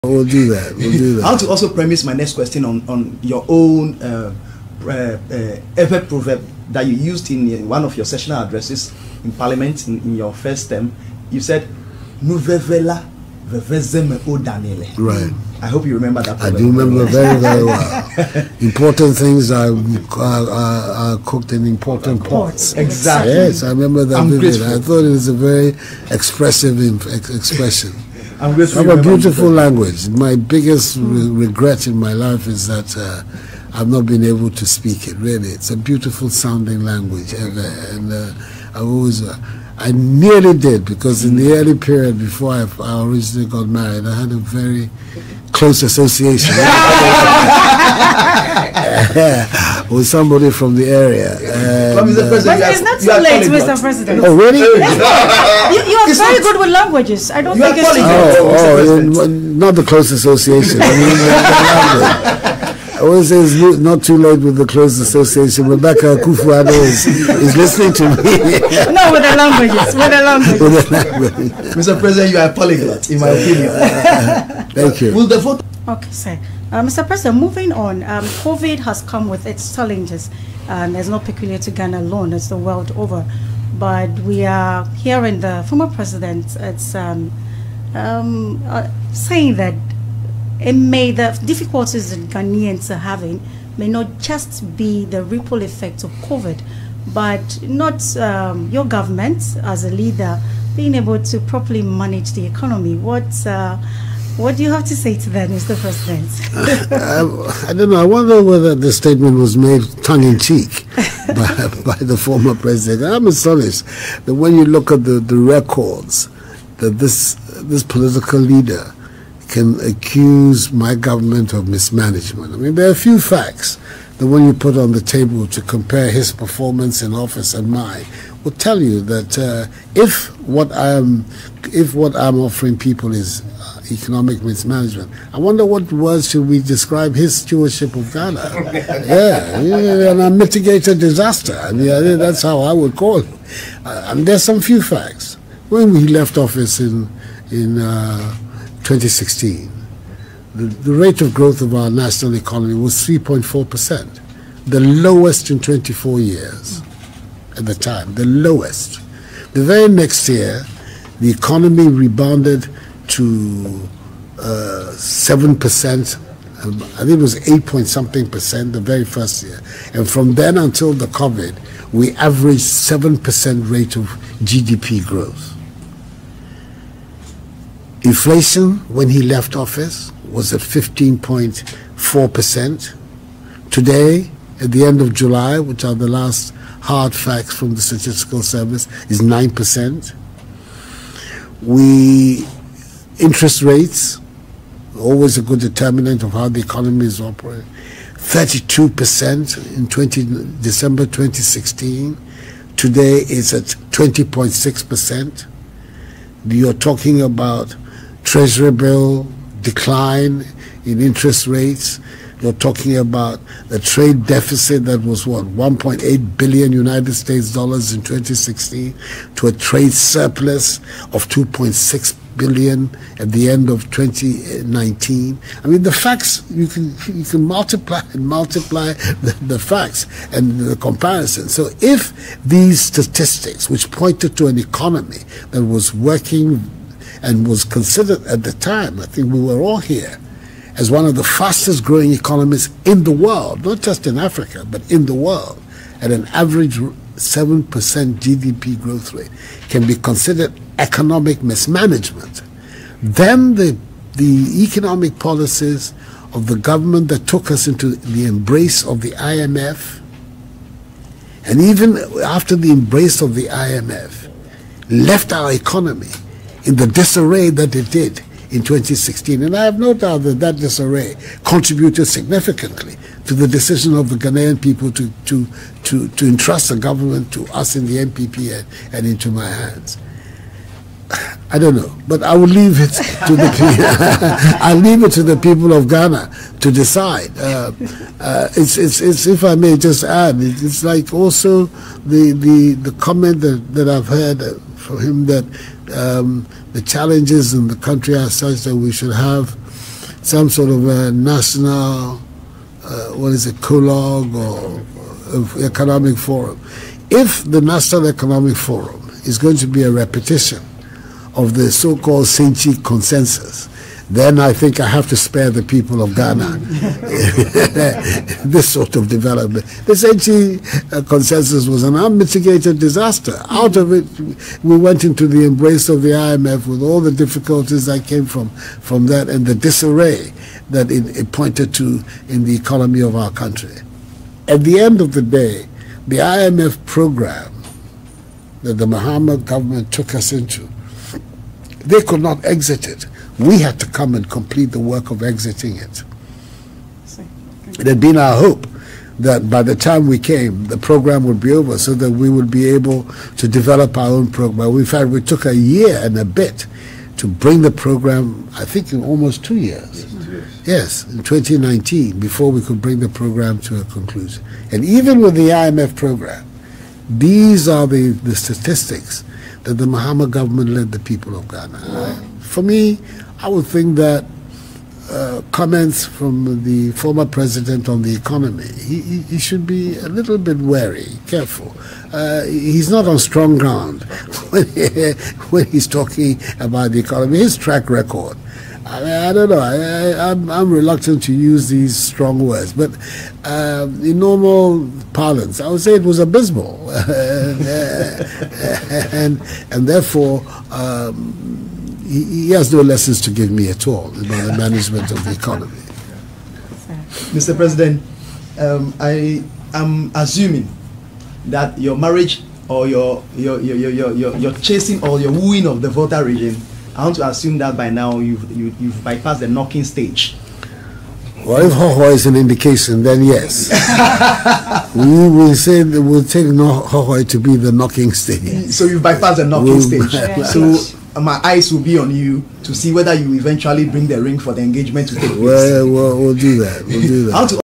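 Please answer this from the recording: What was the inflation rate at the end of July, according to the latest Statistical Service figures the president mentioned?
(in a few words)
9%.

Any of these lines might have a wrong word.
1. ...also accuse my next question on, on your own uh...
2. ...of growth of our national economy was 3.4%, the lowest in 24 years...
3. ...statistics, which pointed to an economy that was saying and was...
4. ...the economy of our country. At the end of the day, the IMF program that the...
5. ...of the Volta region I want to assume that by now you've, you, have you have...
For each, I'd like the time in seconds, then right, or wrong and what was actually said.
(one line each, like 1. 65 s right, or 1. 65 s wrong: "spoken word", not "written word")
1. 1 s wrong: "premise", not "accuse"
2. 151 s right
3. 232 s wrong: "working", not "saying"
4. 332 s right
5. 415 s right.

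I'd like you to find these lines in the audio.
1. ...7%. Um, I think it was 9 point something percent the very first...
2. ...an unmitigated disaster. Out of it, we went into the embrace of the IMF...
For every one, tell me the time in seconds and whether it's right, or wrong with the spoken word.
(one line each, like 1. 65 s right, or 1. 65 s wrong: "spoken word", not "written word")
1. 164 s wrong: "8", not "9"
2. 321 s right.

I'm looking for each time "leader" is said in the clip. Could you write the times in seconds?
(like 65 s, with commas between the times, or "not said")
99 s, 118 s.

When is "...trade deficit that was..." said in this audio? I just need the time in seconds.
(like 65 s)
213 s.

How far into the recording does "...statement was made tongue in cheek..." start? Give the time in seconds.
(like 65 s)
108 s.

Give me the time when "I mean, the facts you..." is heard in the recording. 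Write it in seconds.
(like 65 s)
225 s.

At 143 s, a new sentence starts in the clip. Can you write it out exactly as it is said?
Uh, and there's some few facts.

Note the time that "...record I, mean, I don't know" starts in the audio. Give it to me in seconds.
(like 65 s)
387 s.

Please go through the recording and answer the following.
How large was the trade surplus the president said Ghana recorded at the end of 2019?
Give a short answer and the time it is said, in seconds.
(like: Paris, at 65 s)
2.6 billion dollars, at 221 s.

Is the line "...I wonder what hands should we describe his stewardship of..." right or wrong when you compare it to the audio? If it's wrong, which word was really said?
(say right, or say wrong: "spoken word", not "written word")
wrong: "words", not "hands".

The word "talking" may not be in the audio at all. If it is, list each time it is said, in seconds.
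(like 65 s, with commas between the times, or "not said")
206 s, 212 s, 385 s.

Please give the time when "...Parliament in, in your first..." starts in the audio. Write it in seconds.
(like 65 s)
9 s.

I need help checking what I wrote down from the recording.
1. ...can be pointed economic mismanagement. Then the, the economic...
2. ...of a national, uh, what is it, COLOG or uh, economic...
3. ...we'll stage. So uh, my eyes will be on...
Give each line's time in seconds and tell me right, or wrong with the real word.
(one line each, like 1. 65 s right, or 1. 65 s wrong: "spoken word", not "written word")
1. 249 s wrong: "considered", not "pointed"
2. 300 s right
3. 429 s right.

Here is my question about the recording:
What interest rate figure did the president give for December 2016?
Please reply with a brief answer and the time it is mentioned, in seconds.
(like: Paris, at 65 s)
32%, at 198 s.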